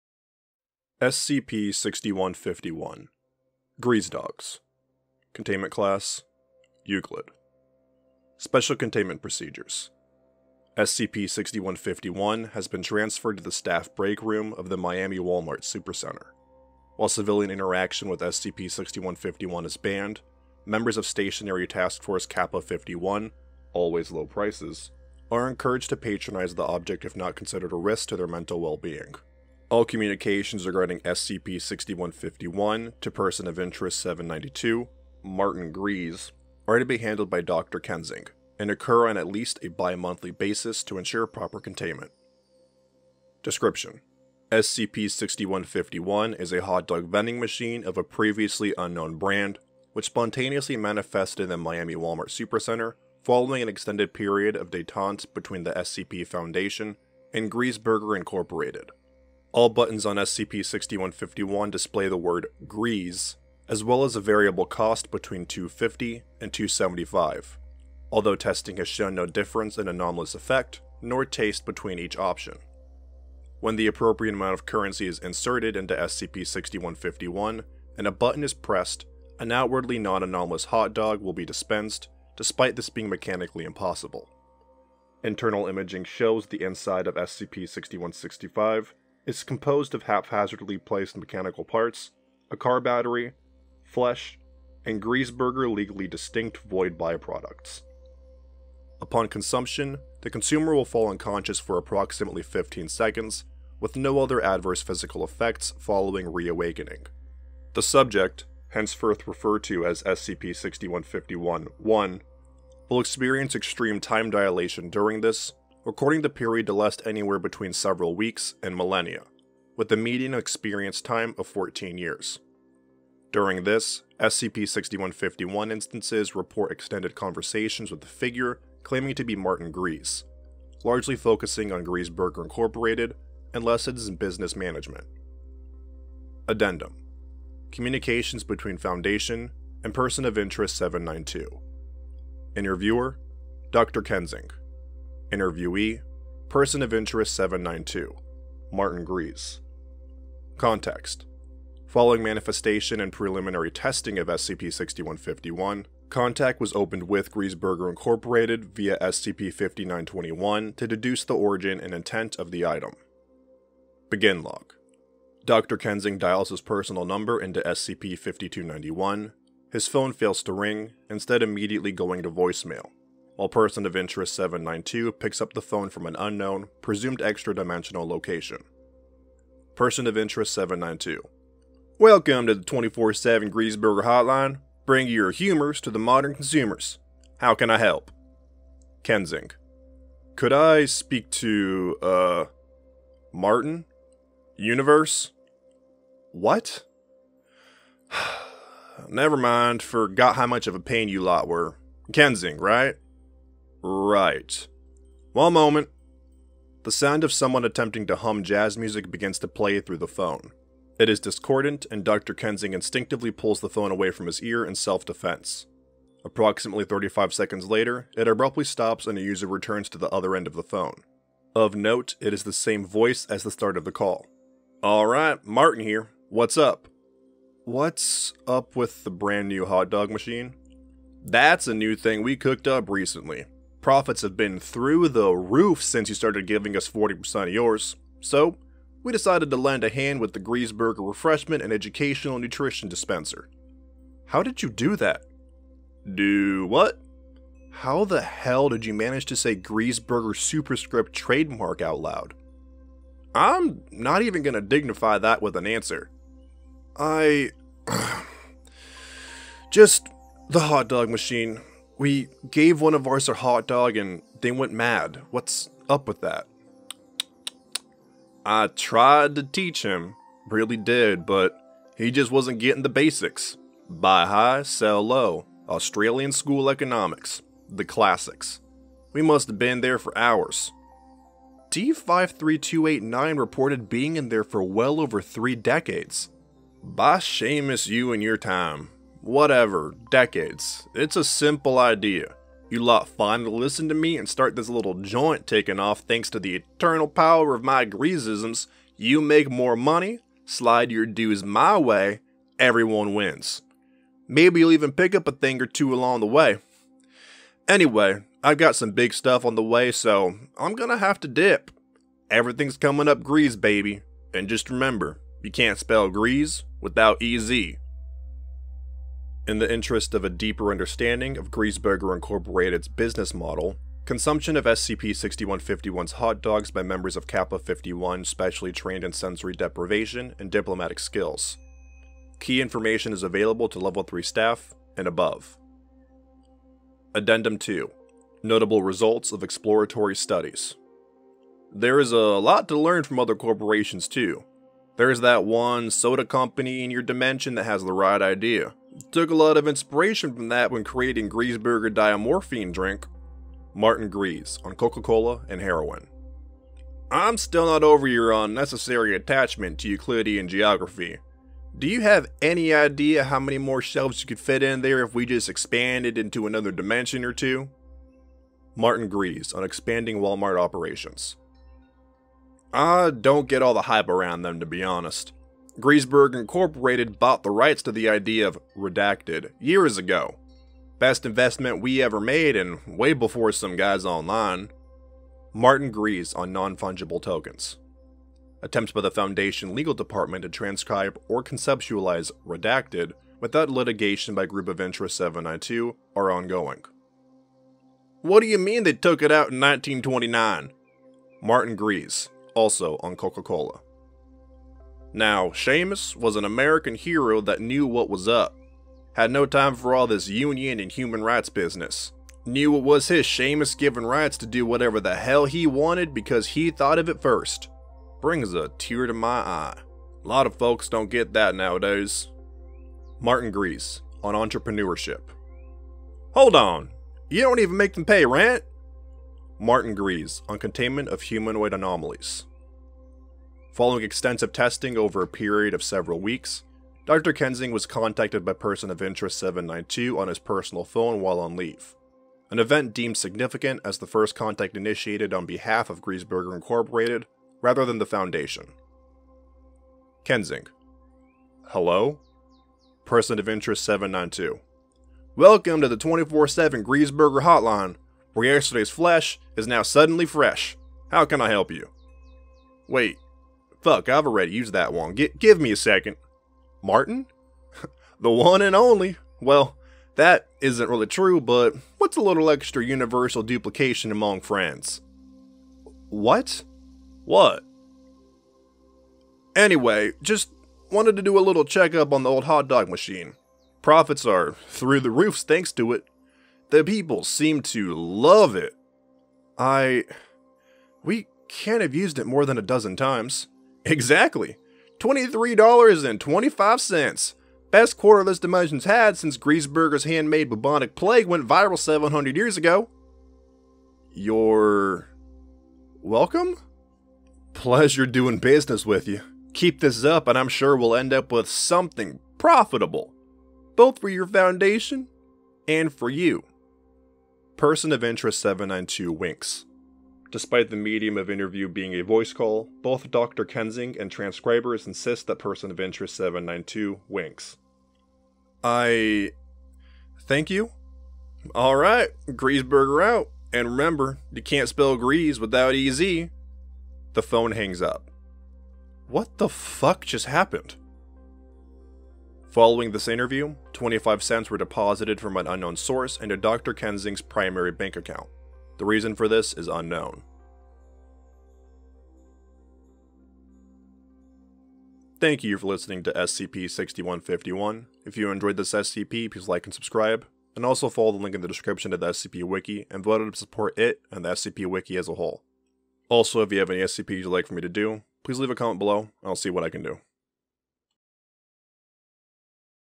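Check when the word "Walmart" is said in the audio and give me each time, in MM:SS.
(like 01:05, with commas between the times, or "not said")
00:15, 00:51, 06:10.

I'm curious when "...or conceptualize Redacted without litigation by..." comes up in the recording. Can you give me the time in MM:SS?
06:31.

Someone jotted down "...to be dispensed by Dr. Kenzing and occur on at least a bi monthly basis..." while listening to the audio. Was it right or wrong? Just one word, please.
wrong.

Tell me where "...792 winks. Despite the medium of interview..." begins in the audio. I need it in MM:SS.
08:38.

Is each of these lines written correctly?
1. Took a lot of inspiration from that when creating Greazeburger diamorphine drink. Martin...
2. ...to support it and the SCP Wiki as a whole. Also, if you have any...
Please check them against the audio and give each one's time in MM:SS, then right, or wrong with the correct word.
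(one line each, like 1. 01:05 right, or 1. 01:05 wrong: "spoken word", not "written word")
1. 05:49 right
2. 09:23 right.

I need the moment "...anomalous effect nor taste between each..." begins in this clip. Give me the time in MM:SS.
01:09.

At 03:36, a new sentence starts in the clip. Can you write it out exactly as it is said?
Approximately 35 seconds later, it abruptly stops and a user returns to the other end of the phone.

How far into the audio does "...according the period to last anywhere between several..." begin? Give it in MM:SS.
01:55.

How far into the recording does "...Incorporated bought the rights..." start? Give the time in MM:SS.
06:16.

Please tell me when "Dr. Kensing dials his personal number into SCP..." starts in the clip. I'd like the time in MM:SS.
02:45.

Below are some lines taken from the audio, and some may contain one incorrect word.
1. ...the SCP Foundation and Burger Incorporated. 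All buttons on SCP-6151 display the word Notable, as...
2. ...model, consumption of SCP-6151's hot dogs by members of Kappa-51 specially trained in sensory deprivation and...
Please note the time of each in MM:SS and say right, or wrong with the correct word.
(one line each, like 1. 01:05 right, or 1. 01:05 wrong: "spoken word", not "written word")
1. 00:55 wrong: "Greaze", not "Notable"
2. 05:23 right.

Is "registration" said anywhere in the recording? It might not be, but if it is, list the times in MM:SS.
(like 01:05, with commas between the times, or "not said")
not said.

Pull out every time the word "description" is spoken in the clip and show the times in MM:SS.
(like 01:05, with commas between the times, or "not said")
00:43, 09:21.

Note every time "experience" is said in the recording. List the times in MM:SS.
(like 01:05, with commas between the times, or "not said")
01:52, 02:00.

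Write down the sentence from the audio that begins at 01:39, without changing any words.
Upon consumption, the consumer will fall unconscious for approximately 15 seconds, with no other adverse physical effects following reawakening.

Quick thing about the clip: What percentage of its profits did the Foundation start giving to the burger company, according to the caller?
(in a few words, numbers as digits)
40%.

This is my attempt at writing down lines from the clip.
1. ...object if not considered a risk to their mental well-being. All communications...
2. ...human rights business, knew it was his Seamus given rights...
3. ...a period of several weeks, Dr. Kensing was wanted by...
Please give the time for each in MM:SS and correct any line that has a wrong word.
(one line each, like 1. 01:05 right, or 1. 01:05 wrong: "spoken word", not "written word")
1. 00:26 right
2. 06:50 right
3. 07:15 wrong: "contacted", not "wanted".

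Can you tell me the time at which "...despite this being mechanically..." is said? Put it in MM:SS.
01:22.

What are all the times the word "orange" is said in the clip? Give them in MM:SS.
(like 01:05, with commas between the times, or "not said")
not said.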